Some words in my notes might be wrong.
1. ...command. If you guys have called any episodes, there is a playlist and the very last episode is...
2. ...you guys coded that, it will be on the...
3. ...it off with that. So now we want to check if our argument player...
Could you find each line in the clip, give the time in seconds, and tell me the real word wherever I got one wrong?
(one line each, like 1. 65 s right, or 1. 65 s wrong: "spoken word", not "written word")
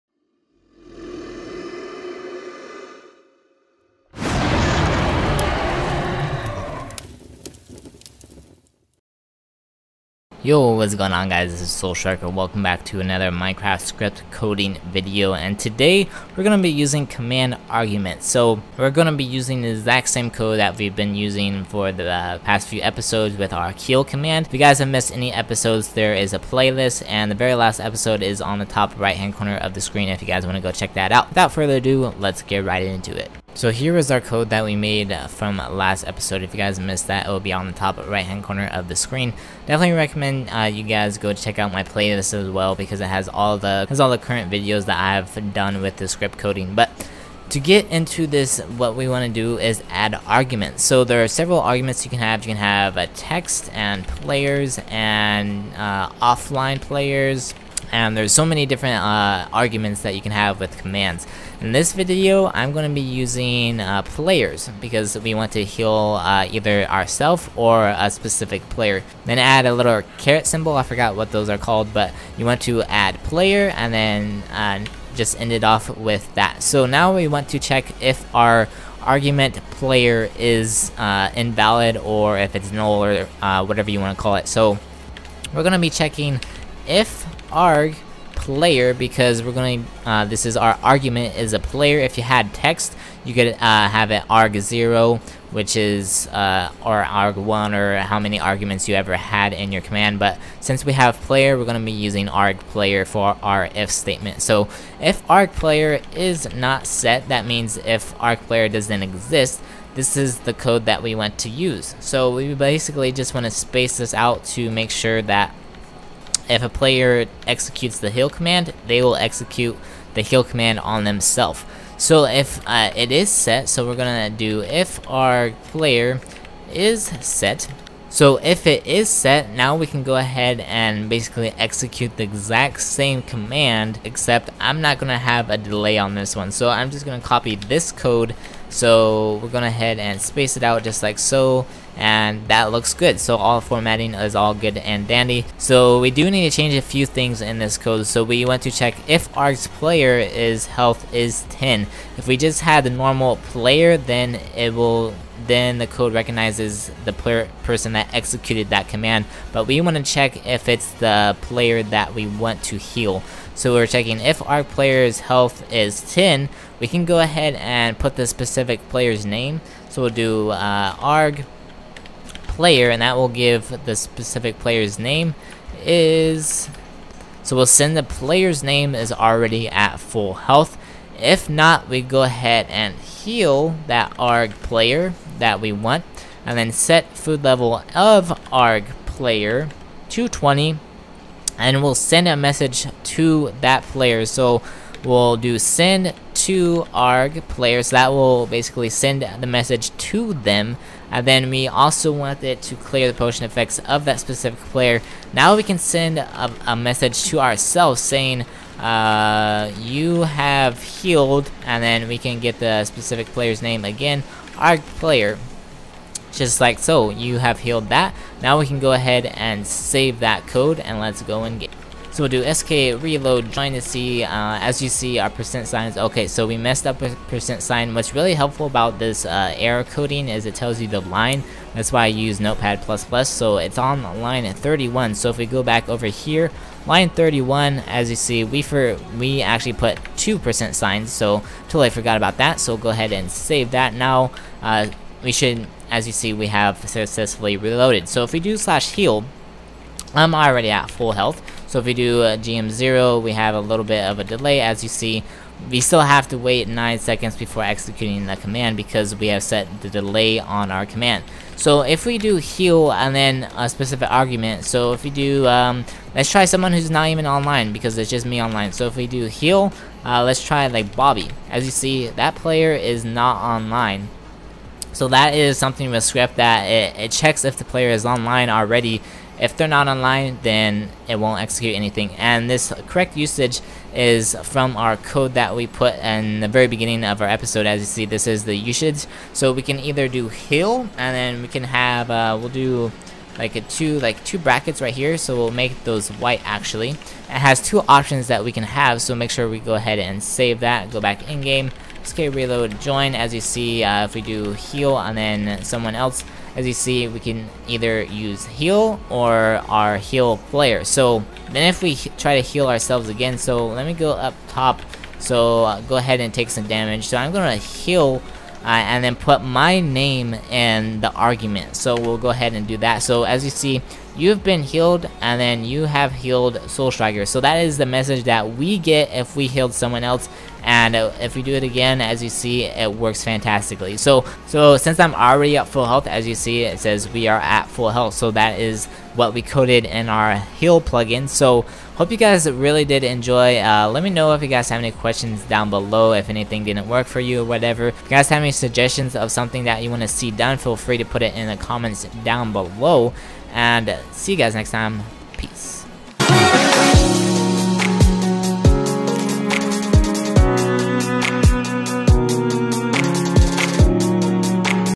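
1. 24 s wrong: "missed", not "called"
2. 36 s wrong: "missed", not "coded"
3. 75 s right.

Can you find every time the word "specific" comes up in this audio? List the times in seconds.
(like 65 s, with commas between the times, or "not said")
68 s, 168 s, 173 s, 204 s, 212 s, 263 s.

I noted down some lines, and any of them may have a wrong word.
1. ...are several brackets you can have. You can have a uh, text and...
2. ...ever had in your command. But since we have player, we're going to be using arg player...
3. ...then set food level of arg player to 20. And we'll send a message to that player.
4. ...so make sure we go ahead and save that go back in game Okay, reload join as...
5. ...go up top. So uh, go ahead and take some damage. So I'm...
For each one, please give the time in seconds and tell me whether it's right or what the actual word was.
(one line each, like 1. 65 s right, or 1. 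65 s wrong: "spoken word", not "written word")
1. 51 s wrong: "arguments", not "brackets"
2. 98 s right
3. 186 s right
4. 299 s right
5. 313 s right.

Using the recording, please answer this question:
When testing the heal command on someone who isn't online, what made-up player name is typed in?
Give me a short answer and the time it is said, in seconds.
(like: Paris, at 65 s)
Bobby, at 270 s.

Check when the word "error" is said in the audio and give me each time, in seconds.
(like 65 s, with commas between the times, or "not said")
229 s.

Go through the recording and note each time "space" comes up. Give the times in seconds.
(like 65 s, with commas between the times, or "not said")
113 s, 140 s.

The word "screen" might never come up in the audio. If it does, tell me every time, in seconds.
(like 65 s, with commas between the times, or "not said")
29 s, 38 s.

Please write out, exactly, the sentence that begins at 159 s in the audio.
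But we want to check if it's the player that we want to heal.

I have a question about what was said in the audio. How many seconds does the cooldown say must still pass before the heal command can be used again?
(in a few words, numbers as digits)
9.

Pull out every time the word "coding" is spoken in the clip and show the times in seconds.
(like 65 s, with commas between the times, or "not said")
14 s, 46 s, 229 s.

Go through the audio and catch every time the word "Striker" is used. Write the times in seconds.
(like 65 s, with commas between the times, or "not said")
11 s, 326 s.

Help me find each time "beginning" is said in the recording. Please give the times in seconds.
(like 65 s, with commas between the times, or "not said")
286 s.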